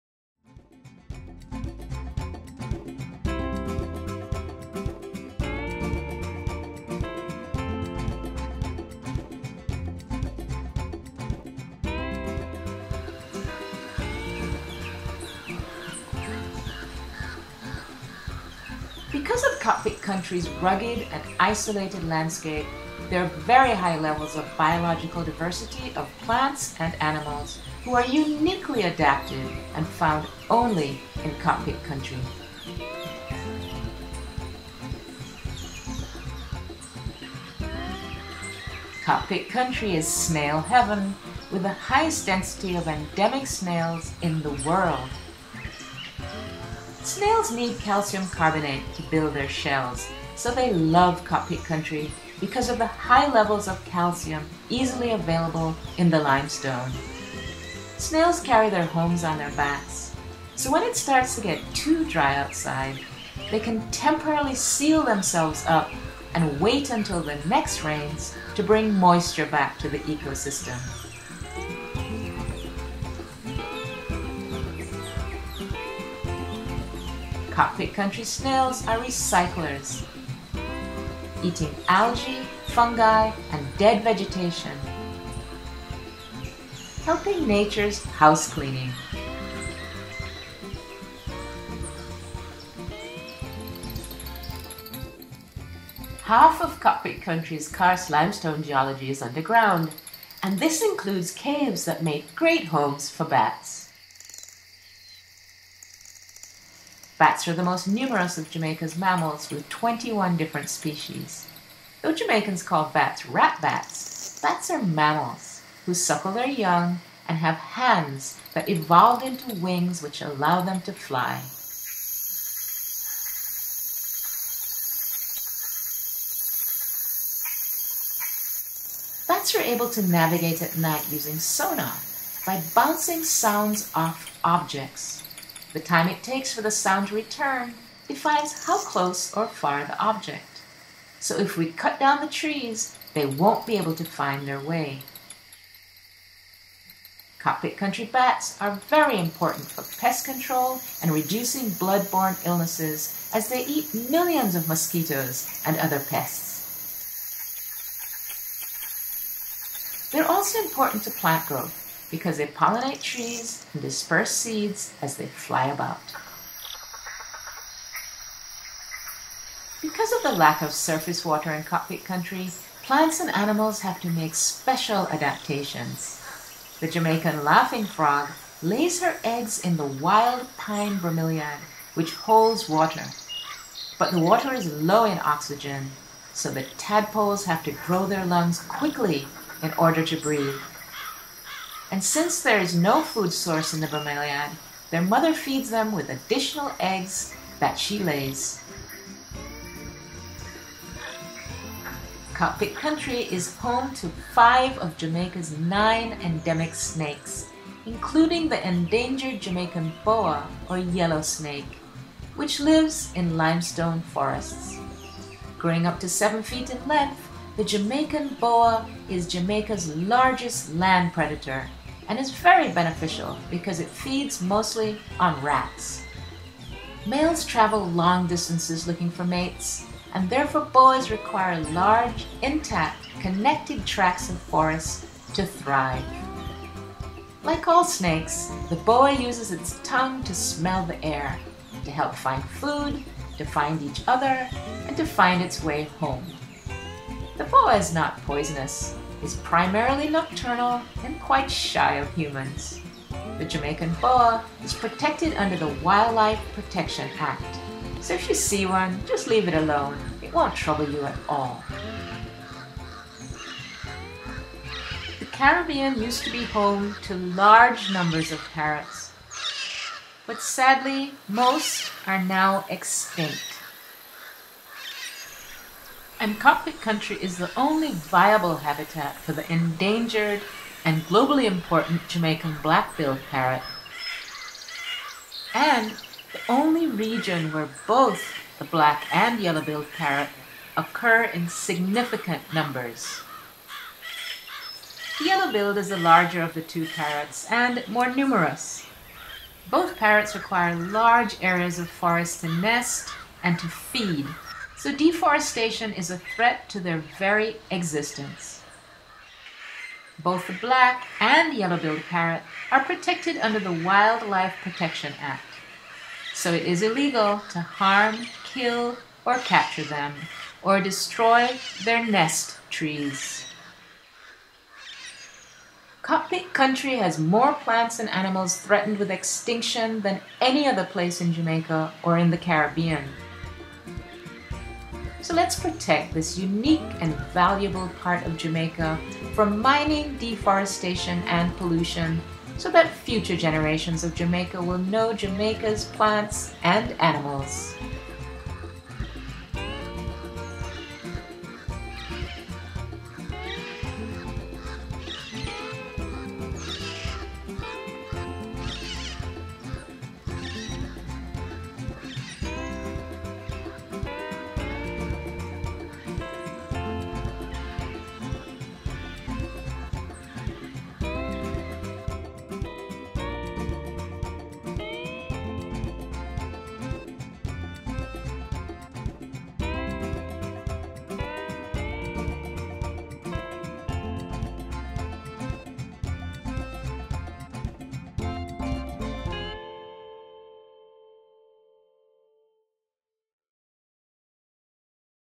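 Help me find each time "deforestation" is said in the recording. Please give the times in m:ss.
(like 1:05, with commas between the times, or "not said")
5:04, 5:40.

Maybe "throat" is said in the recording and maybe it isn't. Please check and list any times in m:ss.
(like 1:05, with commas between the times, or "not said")
not said.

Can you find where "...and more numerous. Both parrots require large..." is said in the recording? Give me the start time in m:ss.
4:57.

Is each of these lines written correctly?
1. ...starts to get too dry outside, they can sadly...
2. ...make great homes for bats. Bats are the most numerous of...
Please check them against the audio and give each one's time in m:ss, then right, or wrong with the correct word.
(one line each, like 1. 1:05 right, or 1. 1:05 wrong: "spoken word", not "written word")
1. 1:00 wrong: "temporarily", not "sadly"
2. 1:42 right.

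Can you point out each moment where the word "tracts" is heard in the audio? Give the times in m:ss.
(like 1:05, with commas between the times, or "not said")
3:53.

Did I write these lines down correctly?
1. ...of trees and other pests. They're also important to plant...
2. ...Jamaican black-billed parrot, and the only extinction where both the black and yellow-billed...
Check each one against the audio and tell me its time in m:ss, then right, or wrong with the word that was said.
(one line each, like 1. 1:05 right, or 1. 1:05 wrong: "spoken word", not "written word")
1. 2:34 wrong: "mosquitoes", not "trees"
2. 4:42 wrong: "region", not "extinction".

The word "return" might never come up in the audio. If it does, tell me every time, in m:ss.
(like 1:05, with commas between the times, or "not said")
2:17.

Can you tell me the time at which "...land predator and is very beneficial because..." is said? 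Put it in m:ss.
3:40.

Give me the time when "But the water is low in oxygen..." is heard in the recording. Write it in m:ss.
3:03.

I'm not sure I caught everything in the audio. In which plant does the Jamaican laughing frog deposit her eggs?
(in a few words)
wild pine bromeliad.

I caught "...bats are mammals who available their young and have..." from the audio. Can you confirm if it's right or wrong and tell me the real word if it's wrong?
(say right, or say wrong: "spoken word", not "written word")
wrong: "suckle", not "available".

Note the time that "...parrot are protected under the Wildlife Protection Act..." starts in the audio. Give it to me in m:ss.
5:12.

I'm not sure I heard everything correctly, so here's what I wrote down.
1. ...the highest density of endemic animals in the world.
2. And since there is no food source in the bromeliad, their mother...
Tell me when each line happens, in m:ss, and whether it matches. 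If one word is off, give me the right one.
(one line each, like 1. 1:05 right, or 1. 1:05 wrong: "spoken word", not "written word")
1. 0:41 wrong: "snails", not "animals"
2. 3:11 right.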